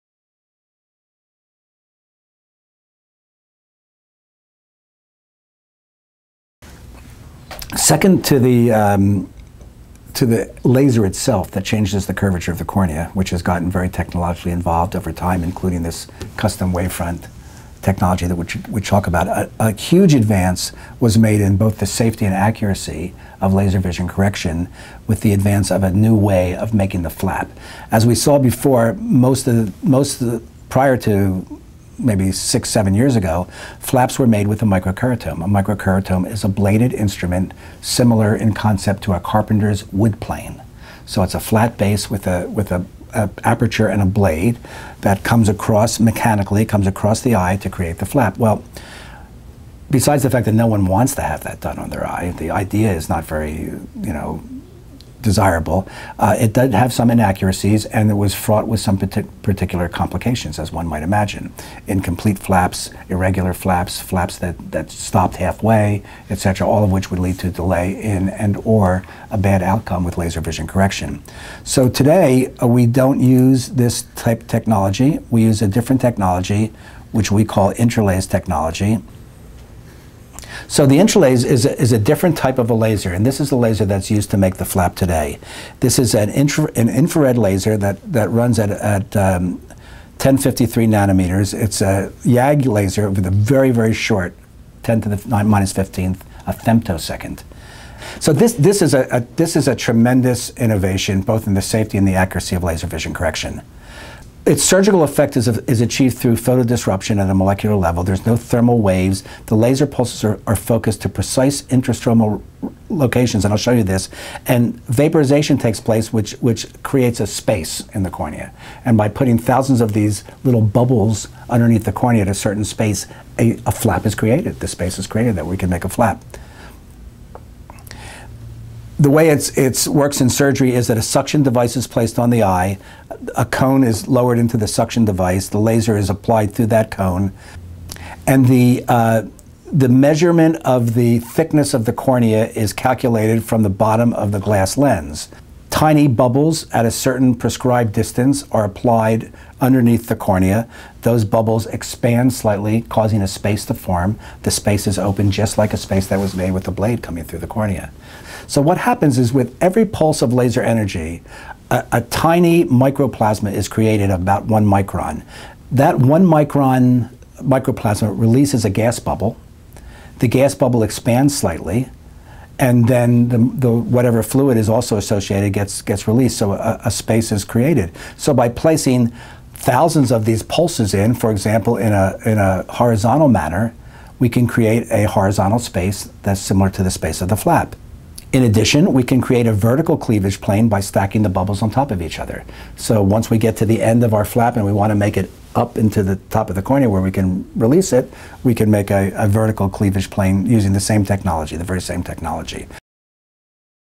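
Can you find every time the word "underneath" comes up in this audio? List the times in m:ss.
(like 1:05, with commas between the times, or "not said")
2:01, 2:29.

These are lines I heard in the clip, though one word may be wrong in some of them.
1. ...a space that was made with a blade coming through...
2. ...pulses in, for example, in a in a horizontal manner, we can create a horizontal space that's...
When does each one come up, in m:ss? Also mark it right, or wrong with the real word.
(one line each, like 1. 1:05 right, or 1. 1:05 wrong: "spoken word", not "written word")
1. 2:35 right
2. 3:00 right.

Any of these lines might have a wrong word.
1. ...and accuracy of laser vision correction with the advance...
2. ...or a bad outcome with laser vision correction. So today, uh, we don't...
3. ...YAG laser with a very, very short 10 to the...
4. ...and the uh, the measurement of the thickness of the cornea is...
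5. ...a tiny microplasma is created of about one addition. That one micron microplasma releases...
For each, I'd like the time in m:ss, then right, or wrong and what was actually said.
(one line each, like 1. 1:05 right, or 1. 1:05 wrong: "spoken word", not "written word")
1. 0:22 right
2. 1:08 right
3. 1:32 right
4. 2:18 right
5. 2:41 wrong: "micron", not "addition".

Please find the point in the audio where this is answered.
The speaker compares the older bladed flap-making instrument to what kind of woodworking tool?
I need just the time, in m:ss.
0:39.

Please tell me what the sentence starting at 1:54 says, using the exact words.
And vaporization takes place, which, which creates a space in the cornea.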